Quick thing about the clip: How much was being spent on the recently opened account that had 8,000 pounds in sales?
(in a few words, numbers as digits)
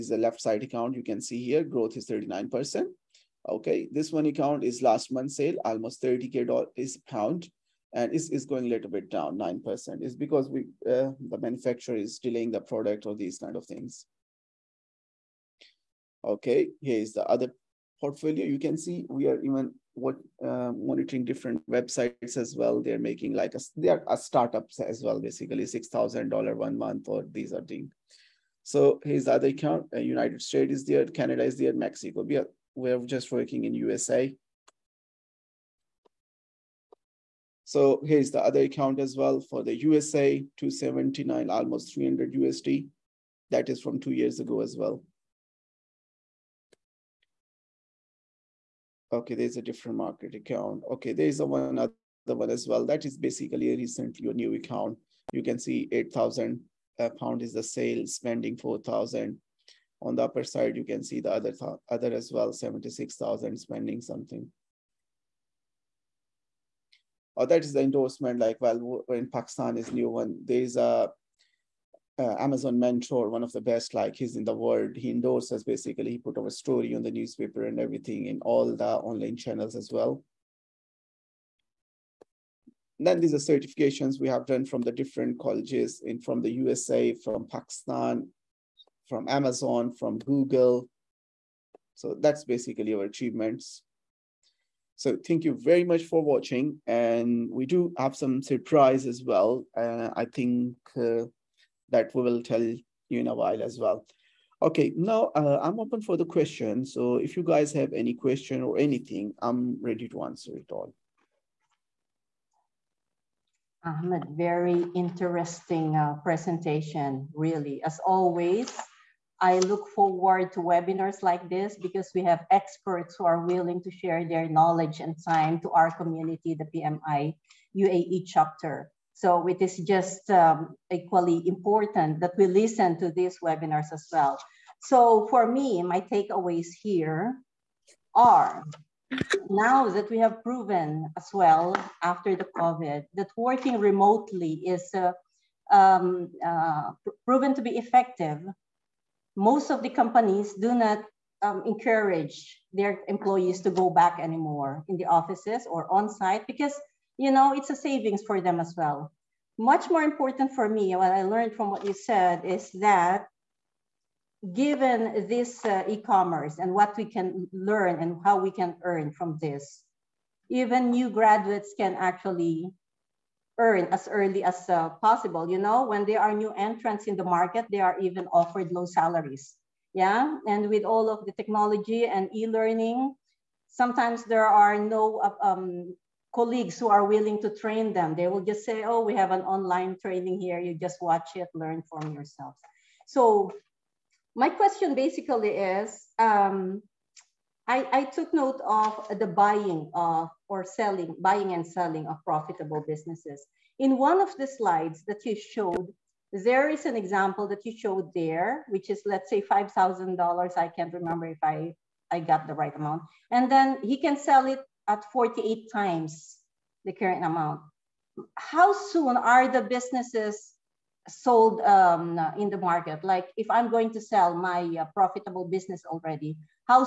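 4,000.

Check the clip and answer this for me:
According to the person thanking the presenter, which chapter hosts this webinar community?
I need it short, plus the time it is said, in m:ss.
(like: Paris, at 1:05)
PMI UAE chapter, at 2:06.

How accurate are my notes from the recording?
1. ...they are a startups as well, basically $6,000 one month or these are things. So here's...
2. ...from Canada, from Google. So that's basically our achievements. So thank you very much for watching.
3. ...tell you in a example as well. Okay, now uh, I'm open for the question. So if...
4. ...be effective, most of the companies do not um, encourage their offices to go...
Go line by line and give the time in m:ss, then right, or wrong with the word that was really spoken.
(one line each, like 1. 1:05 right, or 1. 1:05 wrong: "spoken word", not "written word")
1. 0:23 right
2. 1:29 wrong: "Amazon", not "Canada"
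3. 1:42 wrong: "while", not "example"
4. 2:27 wrong: "employees", not "offices".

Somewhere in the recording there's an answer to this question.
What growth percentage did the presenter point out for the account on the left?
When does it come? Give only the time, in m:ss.
0:01.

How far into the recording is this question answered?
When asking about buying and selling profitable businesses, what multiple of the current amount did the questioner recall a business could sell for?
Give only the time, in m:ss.
3:35.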